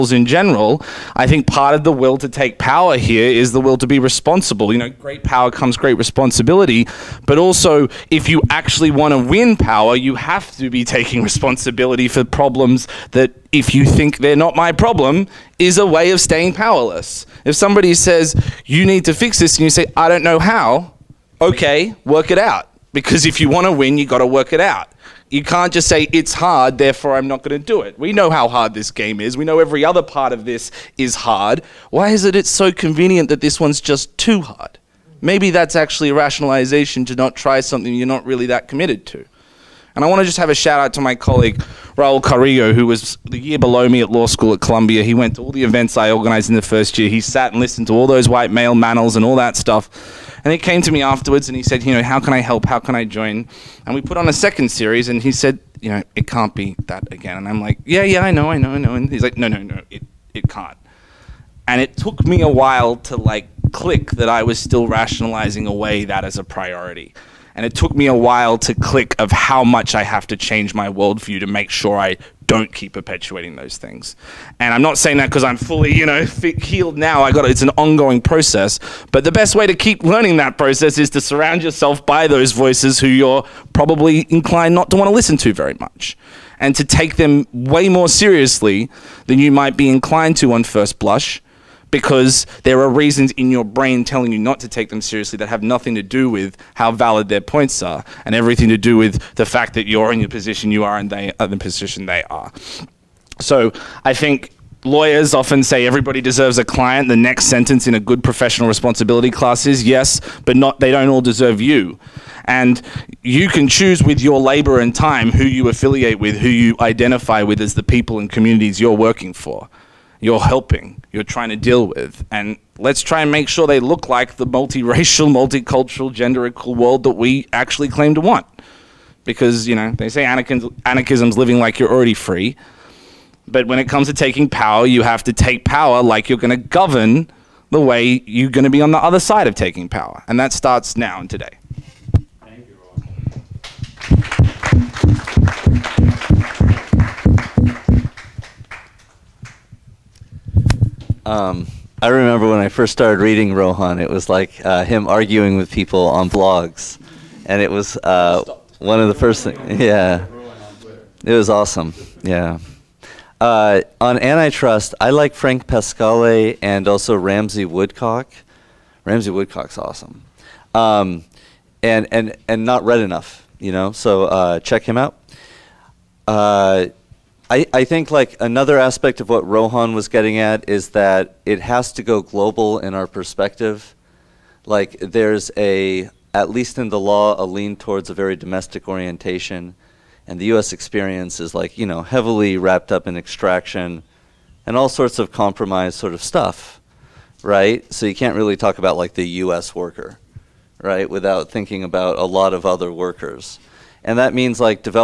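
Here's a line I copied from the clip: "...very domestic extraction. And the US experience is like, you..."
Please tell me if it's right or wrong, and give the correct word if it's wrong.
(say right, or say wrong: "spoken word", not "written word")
wrong: "orientation", not "extraction".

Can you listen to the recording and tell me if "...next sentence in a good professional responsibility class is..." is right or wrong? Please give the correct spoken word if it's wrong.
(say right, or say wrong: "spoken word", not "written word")
right.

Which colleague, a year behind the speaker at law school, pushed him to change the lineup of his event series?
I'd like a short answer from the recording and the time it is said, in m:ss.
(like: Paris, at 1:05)
Raul Carrillo, at 0:41.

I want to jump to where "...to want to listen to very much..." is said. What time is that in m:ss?
1:24.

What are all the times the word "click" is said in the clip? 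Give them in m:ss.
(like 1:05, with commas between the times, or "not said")
1:03, 1:08.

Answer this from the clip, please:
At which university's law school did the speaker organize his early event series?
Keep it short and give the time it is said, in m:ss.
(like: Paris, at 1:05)
Columbia, at 0:44.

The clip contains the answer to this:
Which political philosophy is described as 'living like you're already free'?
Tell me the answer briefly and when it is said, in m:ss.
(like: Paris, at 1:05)
Anarchism, at 2:10.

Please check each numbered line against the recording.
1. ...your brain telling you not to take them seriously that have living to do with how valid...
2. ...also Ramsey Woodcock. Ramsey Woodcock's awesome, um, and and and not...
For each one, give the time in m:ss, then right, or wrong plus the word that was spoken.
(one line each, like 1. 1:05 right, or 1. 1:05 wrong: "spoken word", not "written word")
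1. 1:33 wrong: "nothing", not "living"
2. 2:46 right.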